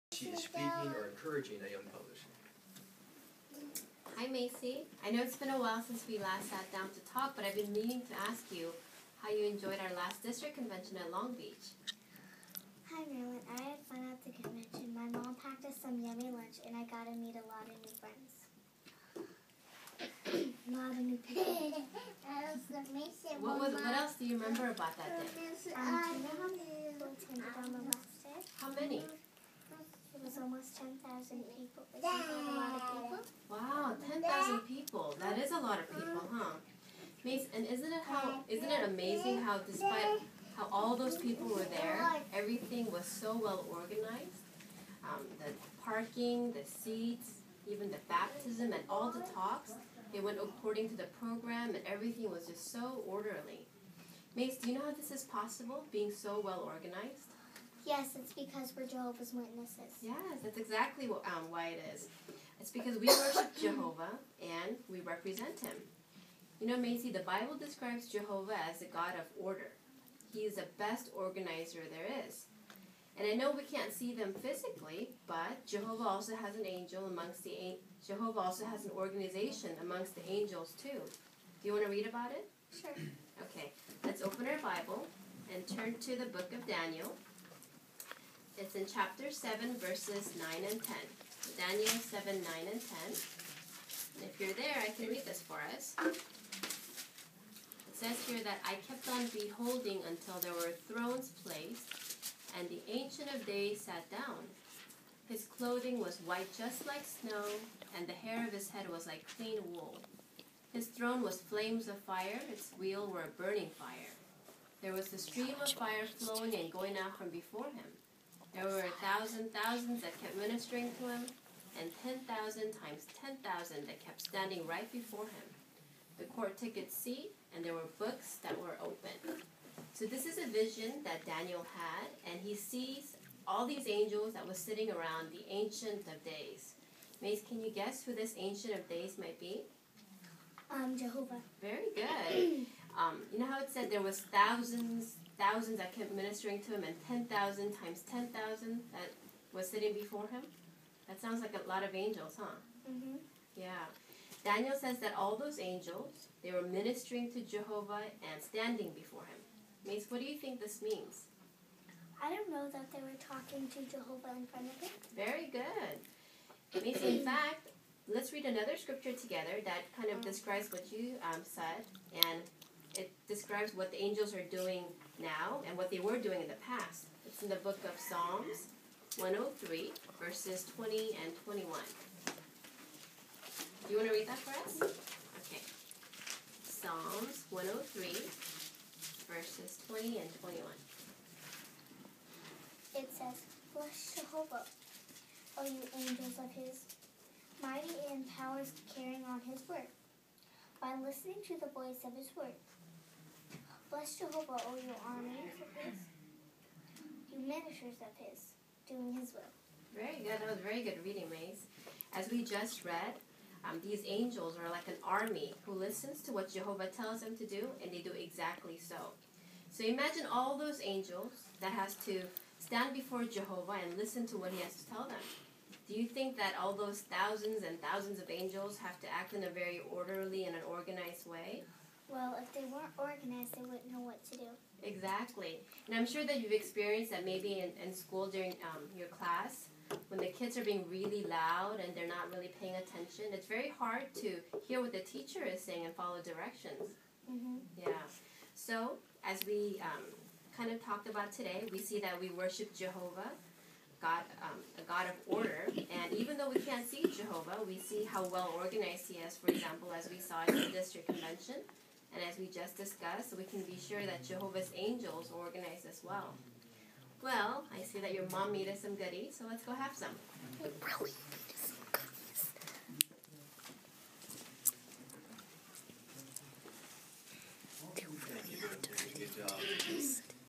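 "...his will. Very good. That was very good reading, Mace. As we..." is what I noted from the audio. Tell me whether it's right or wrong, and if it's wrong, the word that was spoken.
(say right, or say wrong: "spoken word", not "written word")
right.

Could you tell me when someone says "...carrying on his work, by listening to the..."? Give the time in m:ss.
3:18.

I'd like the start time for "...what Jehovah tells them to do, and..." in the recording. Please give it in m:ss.
3:36.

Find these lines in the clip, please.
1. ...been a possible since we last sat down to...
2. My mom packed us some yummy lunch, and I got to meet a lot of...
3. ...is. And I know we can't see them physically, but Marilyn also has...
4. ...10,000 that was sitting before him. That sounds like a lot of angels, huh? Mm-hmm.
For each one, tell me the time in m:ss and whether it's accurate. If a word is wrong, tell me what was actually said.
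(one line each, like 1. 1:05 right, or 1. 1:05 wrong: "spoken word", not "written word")
1. 0:05 wrong: "while", not "possible"
2. 0:14 right
3. 1:12 wrong: "Jehovah", not "Marilyn"
4. 2:28 right.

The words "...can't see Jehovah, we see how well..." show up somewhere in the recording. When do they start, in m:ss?
4:16.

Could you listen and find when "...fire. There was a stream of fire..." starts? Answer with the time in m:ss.
1:53.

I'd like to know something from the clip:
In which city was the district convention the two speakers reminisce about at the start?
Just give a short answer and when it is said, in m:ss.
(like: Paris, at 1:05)
Long Beach, at 0:11.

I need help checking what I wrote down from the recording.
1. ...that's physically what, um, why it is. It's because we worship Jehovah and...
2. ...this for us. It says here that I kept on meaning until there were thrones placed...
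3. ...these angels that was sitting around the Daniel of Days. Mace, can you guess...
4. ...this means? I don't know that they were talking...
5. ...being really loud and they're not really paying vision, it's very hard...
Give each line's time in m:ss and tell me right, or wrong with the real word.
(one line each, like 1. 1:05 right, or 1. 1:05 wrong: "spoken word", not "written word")
1. 1:00 wrong: "exactly", not "physically"
2. 1:35 wrong: "beholding", not "meaning"
3. 2:13 wrong: "Ancient", not "Daniel"
4. 2:40 right
5. 4:00 wrong: "attention", not "vision".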